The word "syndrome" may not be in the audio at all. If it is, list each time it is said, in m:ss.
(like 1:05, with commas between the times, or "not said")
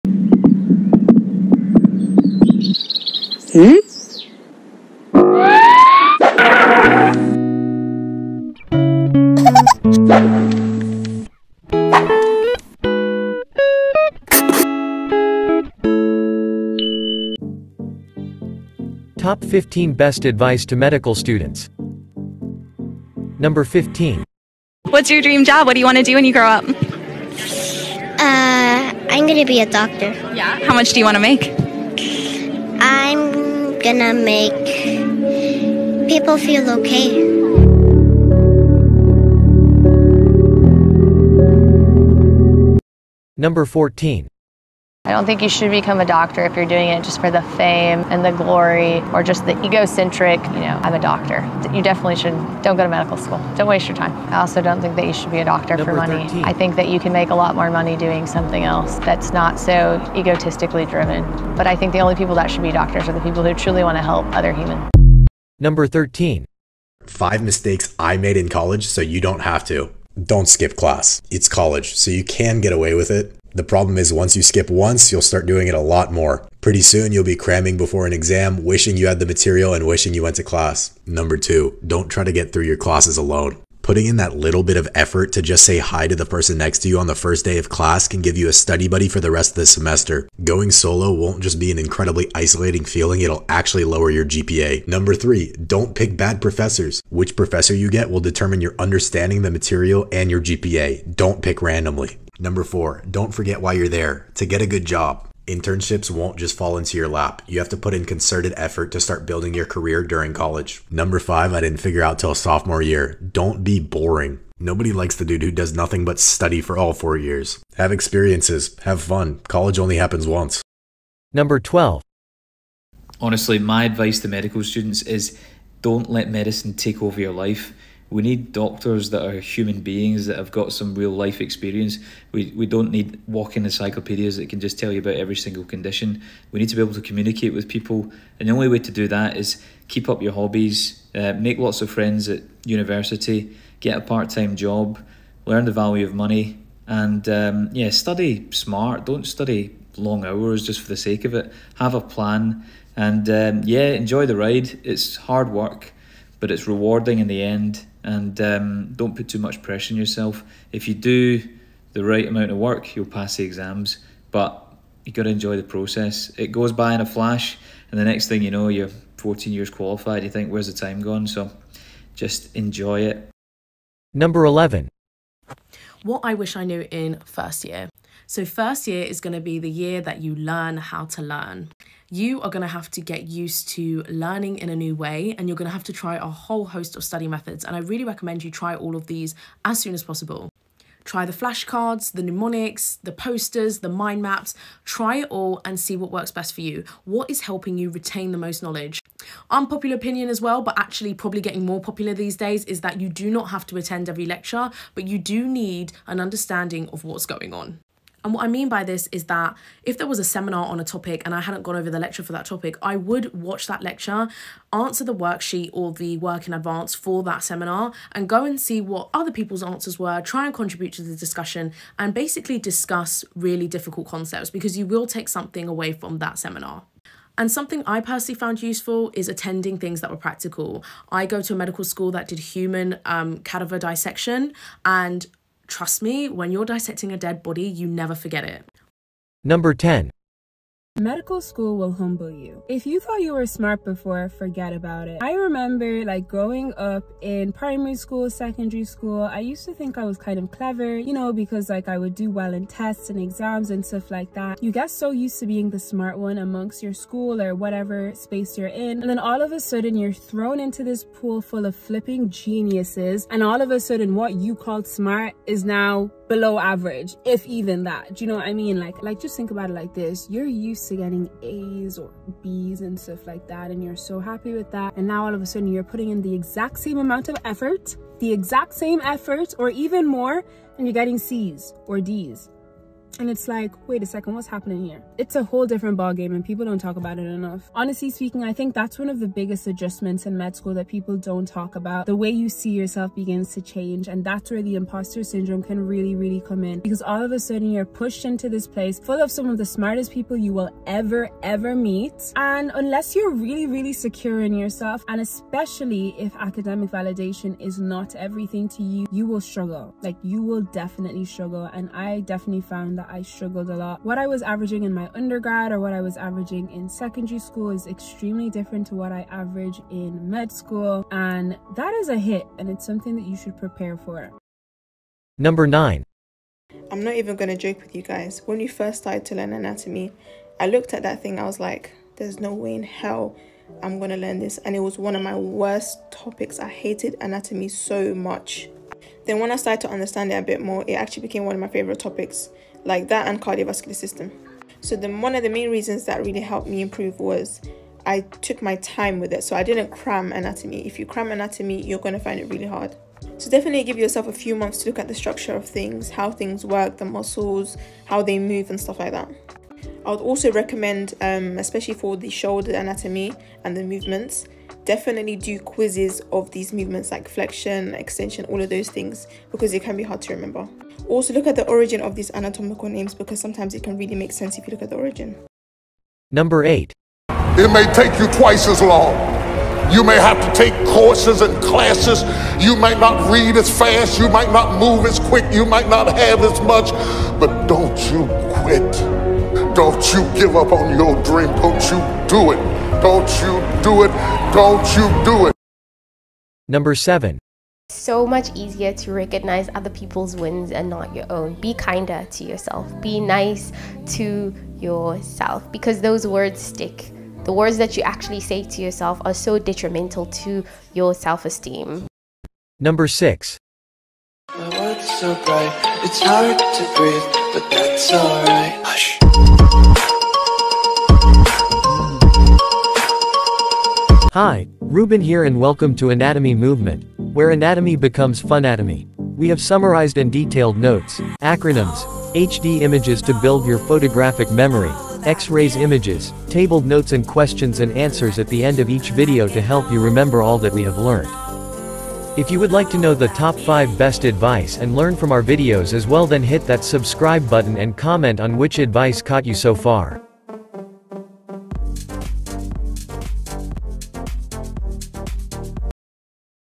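4:55.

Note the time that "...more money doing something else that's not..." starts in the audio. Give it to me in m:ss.
0:57.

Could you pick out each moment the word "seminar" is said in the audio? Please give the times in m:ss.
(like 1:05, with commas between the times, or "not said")
3:30, 3:37, 3:46.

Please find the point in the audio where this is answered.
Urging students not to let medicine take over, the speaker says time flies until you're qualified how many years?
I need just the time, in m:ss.
2:49.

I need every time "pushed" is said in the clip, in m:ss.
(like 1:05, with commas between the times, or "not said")
4:57.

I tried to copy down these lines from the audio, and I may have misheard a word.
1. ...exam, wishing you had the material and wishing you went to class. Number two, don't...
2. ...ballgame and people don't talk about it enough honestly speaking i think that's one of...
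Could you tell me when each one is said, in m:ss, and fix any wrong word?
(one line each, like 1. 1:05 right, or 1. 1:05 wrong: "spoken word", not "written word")
1. 1:18 right
2. 4:45 right.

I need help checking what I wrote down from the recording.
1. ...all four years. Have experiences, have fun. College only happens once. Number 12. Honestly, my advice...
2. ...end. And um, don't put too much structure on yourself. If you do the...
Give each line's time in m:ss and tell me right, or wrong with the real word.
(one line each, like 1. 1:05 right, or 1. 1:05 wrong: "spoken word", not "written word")
1. 1:56 right
2. 2:37 wrong: "pressure", not "structure".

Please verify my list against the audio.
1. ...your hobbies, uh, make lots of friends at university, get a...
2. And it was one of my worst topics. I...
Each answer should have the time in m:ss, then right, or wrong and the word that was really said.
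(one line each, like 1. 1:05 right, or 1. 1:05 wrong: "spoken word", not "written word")
1. 2:20 right
2. 5:34 right.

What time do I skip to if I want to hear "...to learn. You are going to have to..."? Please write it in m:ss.
3:01.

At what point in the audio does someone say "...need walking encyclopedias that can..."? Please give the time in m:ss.
2:12.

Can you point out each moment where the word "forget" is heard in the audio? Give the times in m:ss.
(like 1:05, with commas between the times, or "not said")
1:43, 3:58, 4:04.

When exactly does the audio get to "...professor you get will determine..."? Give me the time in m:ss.
1:37.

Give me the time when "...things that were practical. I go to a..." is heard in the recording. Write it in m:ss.
3:49.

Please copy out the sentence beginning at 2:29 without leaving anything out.
Don't study long hours just for the sake of it.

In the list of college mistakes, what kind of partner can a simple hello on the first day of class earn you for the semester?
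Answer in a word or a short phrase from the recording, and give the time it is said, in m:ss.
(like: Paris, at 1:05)
study buddy, at 1:28.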